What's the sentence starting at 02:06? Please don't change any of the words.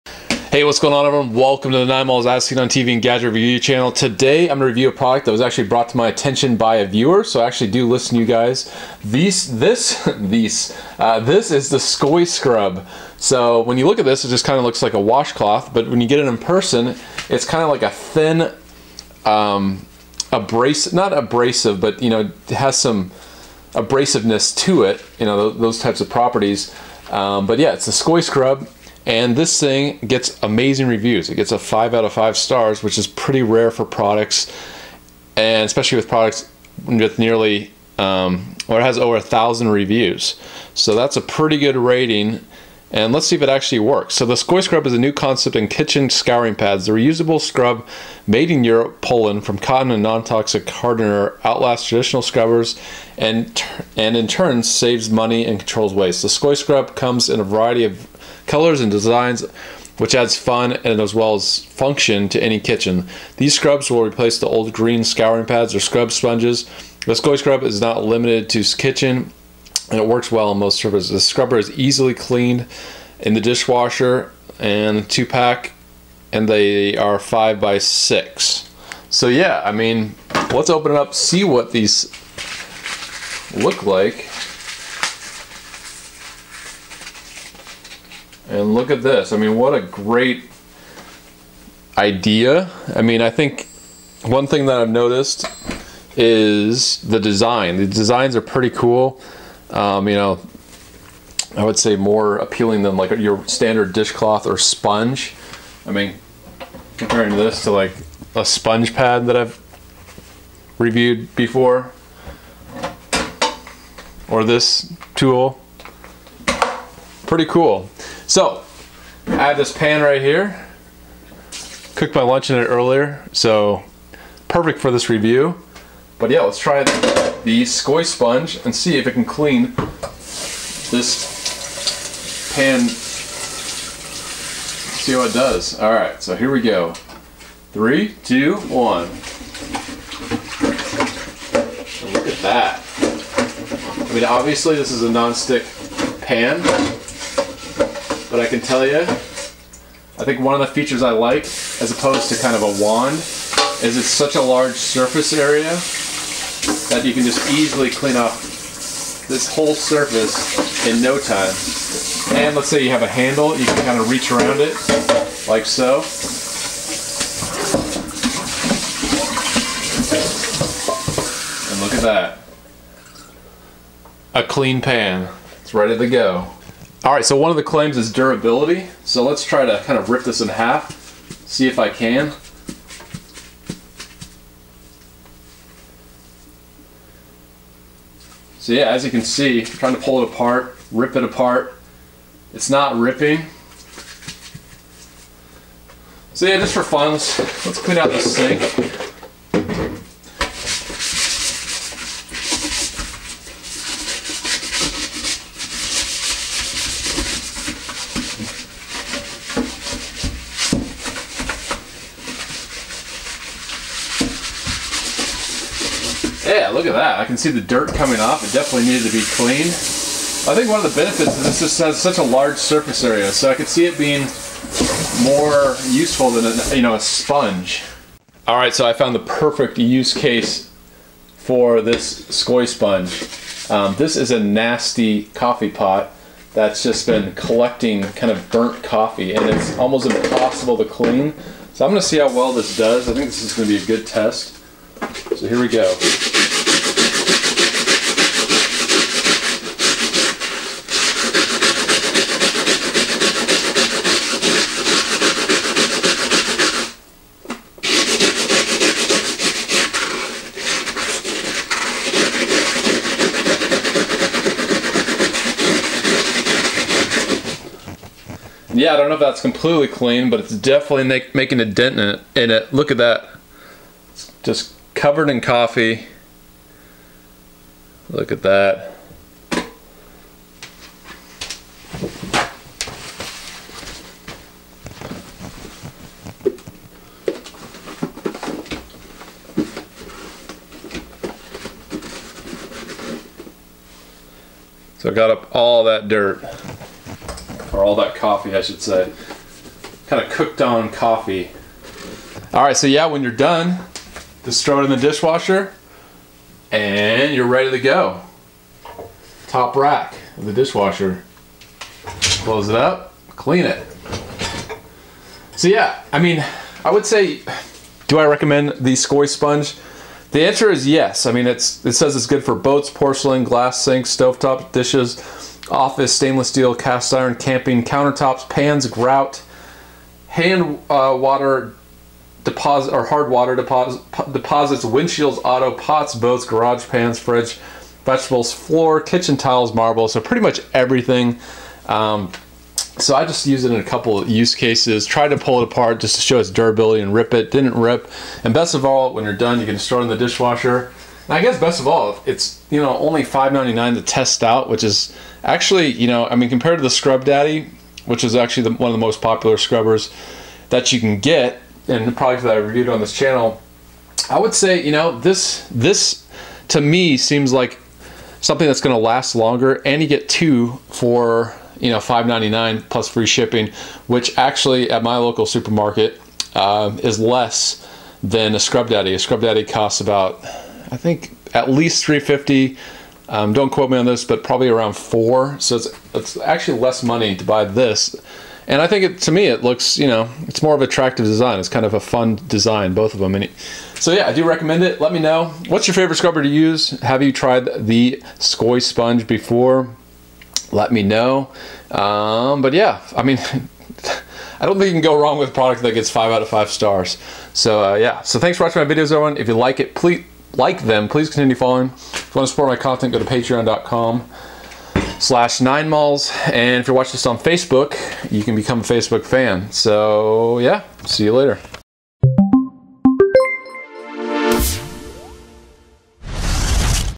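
But yeah, let's try the Skoy sponge and see if it can clean this pan.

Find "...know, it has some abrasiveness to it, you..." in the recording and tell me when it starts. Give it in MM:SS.
00:22.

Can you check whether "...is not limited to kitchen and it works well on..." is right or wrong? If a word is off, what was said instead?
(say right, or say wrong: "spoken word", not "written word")
right.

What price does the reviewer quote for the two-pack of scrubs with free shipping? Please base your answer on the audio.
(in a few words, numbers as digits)
$5.99.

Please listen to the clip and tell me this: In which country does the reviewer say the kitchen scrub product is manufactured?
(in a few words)
Poland.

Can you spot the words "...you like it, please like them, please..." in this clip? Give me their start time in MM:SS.
06:49.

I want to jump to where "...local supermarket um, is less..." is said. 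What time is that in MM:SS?
06:15.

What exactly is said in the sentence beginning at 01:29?
I mean, what a great idea.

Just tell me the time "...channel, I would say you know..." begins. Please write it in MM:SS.
06:03.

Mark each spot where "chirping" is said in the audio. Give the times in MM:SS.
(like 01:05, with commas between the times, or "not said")
not said.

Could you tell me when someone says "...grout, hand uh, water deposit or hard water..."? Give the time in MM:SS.
05:28.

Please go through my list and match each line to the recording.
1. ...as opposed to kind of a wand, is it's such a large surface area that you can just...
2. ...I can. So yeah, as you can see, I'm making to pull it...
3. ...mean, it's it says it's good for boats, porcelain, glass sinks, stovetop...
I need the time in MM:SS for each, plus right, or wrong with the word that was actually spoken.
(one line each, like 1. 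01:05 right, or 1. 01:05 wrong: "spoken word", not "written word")
1. 02:31 right
2. 03:01 wrong: "trying", not "making"
3. 05:21 right.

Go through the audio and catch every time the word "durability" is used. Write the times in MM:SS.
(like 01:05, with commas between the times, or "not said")
02:58, 05:46.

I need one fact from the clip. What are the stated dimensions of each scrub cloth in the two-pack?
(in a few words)
5 by 6.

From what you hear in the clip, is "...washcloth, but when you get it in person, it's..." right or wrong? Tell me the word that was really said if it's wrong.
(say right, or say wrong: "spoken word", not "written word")
right.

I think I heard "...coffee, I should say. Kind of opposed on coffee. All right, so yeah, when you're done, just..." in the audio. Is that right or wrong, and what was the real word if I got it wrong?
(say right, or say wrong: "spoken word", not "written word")
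wrong: "cooked", not "opposed".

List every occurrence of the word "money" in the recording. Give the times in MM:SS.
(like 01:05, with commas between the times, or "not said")
00:55, 06:27.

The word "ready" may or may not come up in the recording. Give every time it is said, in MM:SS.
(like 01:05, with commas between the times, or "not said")
02:55, 05:07.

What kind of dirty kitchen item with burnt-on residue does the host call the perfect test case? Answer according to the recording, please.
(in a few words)
Coffee pot.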